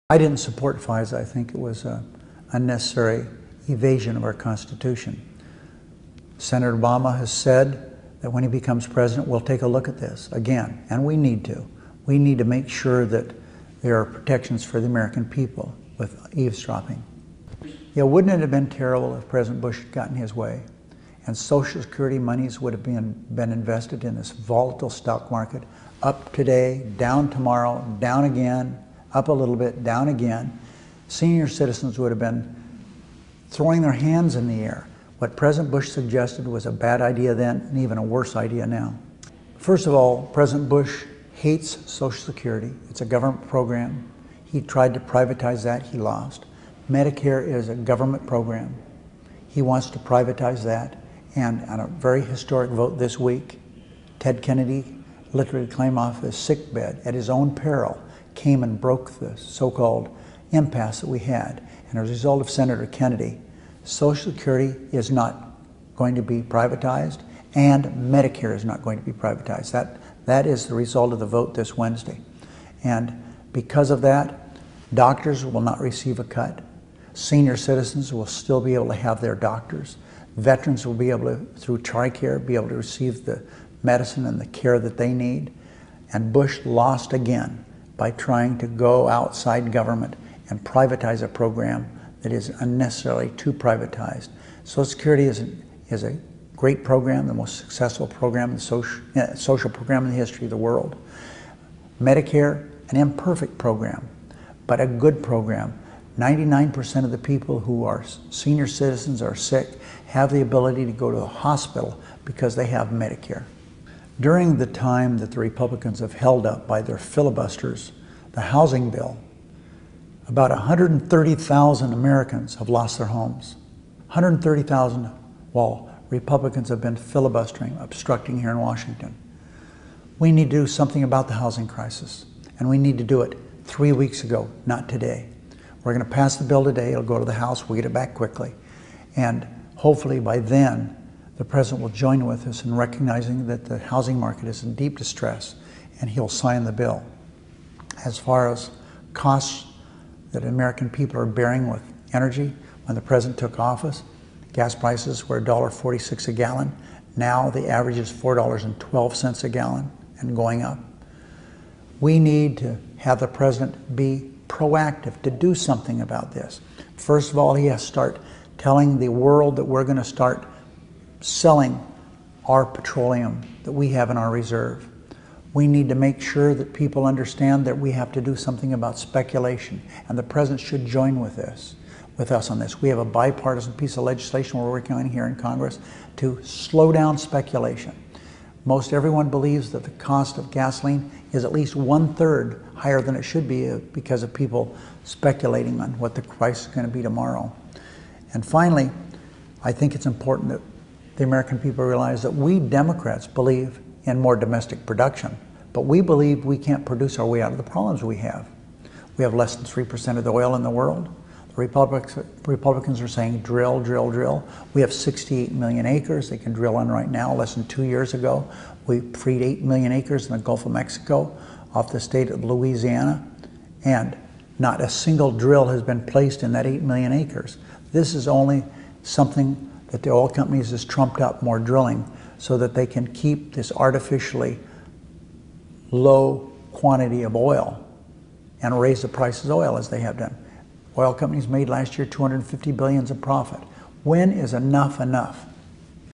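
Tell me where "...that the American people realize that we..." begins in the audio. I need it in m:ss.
3:20.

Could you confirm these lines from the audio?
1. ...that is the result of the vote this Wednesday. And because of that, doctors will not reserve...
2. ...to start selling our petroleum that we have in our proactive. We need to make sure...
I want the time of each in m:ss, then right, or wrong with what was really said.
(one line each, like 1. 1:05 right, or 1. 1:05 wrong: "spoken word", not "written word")
1. 1:10 wrong: "receive", not "reserve"
2. 2:49 wrong: "reserve", not "proactive".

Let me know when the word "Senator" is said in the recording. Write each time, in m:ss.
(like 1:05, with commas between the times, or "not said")
0:06, 1:02.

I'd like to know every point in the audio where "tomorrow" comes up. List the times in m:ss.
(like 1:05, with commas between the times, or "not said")
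0:27, 3:17.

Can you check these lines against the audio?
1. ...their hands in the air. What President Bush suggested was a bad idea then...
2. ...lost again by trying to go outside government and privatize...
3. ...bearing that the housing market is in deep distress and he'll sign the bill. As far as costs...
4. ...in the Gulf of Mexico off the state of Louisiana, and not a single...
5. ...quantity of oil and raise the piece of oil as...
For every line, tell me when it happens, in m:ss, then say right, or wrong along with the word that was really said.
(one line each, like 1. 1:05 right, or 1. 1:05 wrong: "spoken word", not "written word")
1. 0:33 right
2. 1:26 right
3. 2:22 wrong: "recognizing", not "bearing"
4. 3:40 right
5. 3:56 wrong: "price", not "piece".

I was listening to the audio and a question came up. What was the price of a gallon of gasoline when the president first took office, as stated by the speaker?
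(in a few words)
$1.46.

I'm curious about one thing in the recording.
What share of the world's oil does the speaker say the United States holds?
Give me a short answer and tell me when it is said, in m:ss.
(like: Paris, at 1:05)
less than 3%, at 3:29.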